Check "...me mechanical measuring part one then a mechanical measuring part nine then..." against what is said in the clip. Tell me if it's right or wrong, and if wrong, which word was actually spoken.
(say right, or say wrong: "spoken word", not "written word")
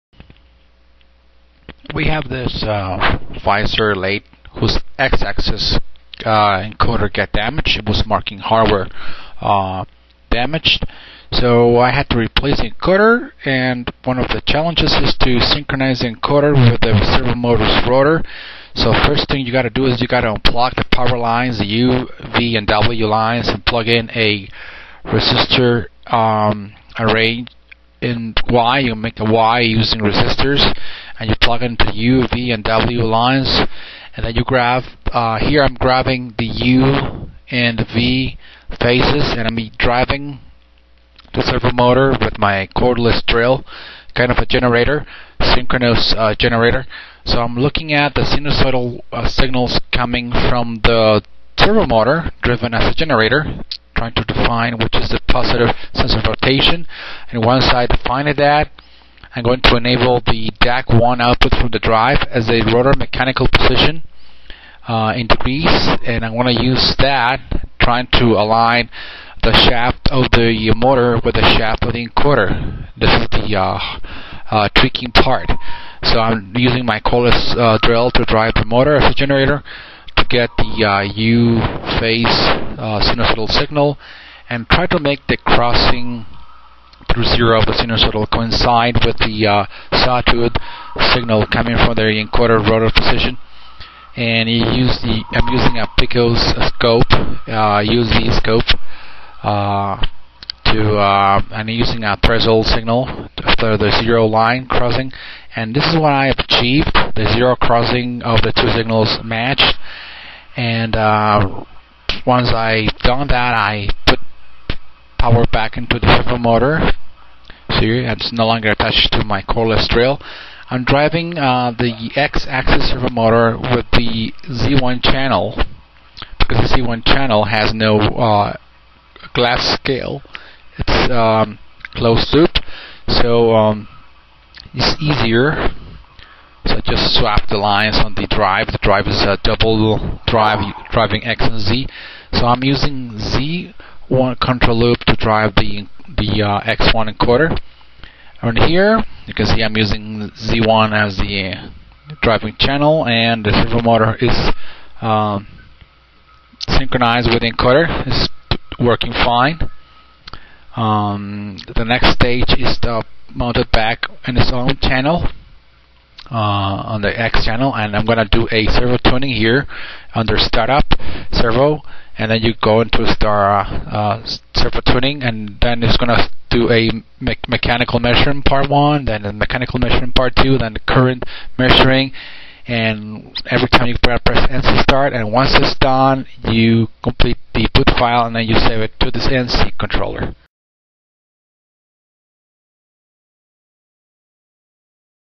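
wrong: "two", not "nine".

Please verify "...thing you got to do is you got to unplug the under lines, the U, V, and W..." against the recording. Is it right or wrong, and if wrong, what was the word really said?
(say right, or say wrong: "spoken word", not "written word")
wrong: "power", not "under".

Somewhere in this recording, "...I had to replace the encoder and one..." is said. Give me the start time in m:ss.
0:11.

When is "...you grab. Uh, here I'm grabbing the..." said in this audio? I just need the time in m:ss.
0:34.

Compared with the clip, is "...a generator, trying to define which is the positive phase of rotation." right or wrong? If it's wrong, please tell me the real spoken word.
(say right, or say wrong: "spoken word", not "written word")
wrong: "sense", not "phase".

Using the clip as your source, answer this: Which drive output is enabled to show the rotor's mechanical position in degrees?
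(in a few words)
DAC1.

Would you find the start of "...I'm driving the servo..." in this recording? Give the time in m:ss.
0:39.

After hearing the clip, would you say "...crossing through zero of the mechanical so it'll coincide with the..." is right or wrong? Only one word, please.
wrong.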